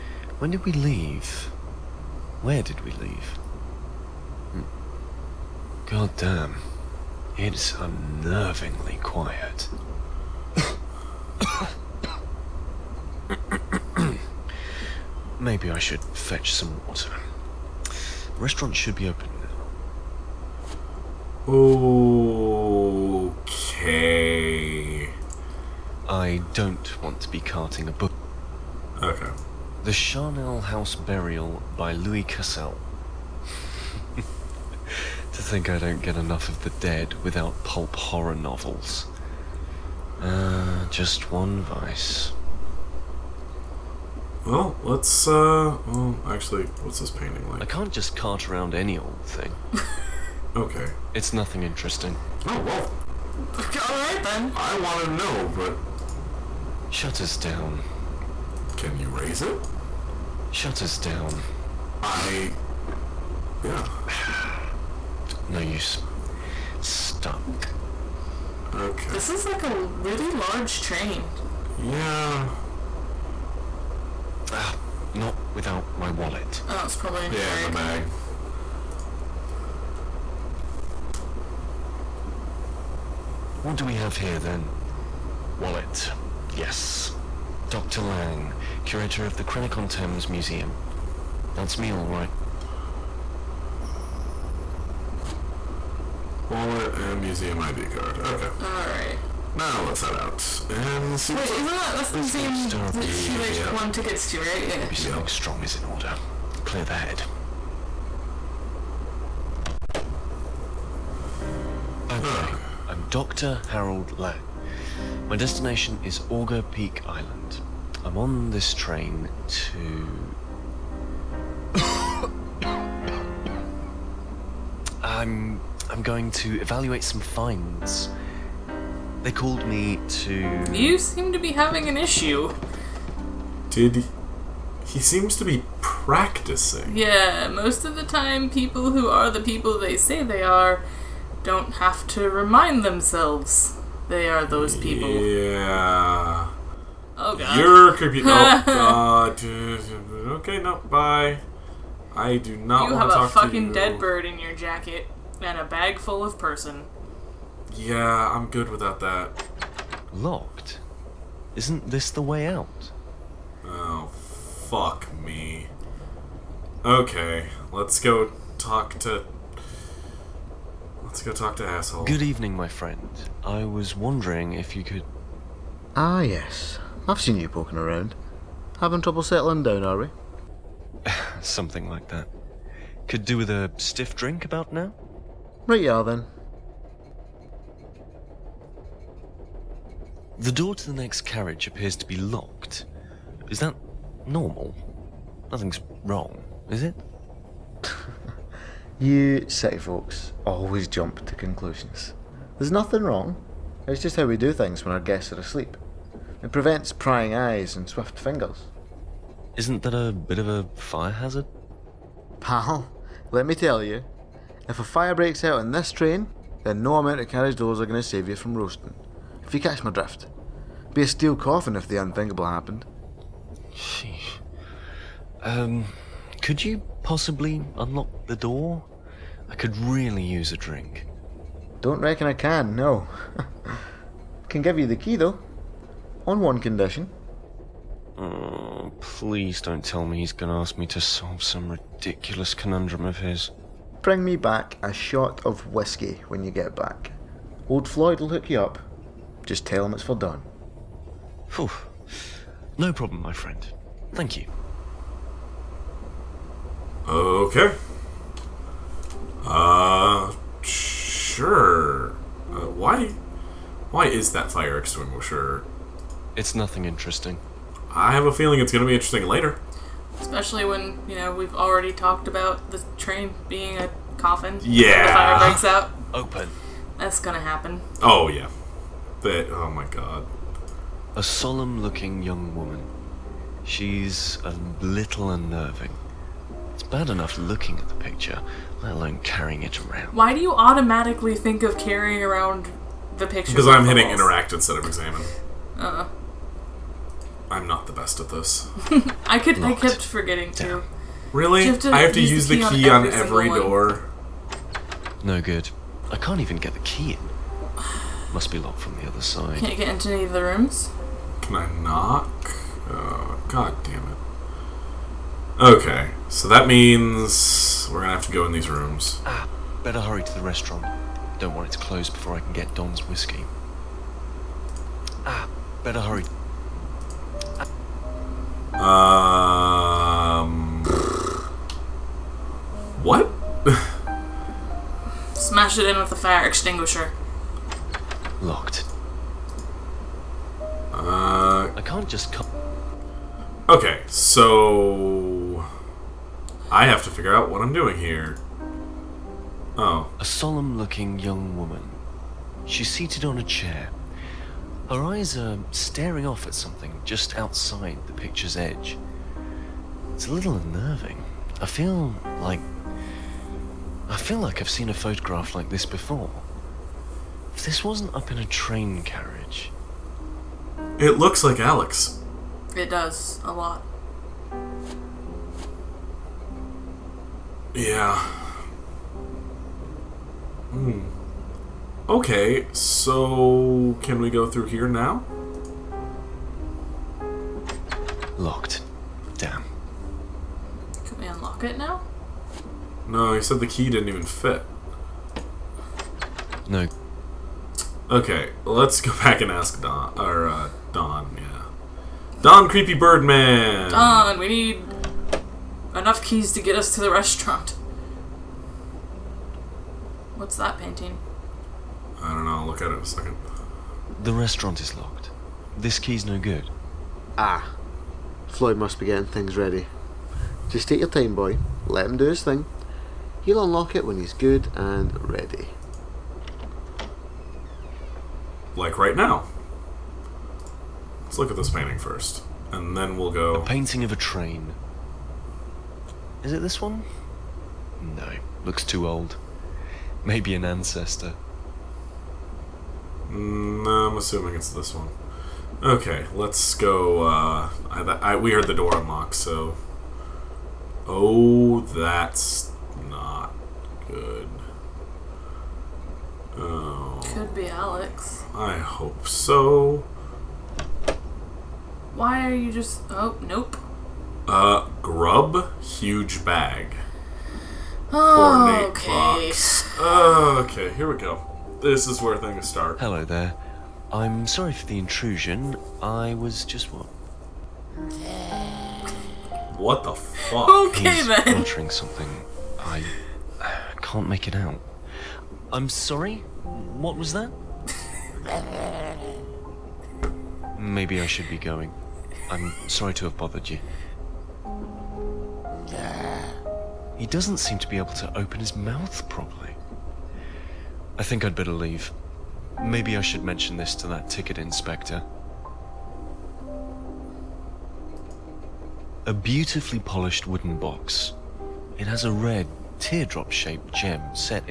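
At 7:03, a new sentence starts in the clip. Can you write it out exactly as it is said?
He'll unlock it when he's good and ready like right now.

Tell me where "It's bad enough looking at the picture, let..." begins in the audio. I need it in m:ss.
4:46.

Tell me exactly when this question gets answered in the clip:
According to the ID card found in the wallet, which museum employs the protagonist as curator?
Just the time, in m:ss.
1:29.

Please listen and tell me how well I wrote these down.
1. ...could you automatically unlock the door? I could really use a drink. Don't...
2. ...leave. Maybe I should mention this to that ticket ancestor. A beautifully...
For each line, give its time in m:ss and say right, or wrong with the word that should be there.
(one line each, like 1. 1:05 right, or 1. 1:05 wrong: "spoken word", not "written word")
1. 3:46 wrong: "possibly", not "automatically"
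2. 8:21 wrong: "inspector", not "ancestor".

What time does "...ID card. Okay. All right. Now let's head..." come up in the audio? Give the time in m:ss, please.
1:37.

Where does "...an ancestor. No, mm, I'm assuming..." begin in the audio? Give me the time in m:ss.
7:20.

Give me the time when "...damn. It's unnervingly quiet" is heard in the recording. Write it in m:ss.
0:06.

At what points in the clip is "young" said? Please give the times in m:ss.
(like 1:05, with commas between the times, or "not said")
4:42, 5:51.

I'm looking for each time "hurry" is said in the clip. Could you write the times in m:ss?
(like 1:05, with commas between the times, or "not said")
5:20, 5:26.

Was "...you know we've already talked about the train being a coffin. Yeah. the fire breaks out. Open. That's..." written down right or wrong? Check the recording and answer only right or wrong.
right.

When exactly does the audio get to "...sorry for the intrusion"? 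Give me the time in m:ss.
7:54.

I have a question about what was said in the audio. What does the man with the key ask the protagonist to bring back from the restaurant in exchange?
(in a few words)
A shot of whiskey.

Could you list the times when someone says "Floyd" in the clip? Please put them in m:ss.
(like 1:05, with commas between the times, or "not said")
4:07, 6:58.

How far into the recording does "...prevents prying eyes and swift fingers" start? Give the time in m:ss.
3:26.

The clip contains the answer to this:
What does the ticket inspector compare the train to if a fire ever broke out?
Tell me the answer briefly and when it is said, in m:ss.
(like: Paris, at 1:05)
A steel coffin, at 3:41.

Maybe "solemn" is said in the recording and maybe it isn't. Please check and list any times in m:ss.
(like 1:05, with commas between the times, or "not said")
4:41, 5:50.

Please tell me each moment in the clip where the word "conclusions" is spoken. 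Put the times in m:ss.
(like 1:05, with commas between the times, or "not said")
3:21.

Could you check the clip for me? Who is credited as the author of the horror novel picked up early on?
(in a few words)
Louis Cassel.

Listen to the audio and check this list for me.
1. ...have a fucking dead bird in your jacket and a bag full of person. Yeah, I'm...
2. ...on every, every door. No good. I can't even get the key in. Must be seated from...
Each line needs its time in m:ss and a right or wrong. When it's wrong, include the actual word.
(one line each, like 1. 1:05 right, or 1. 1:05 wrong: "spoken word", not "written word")
1. 2:32 right
2. 5:03 wrong: "locked", not "seated".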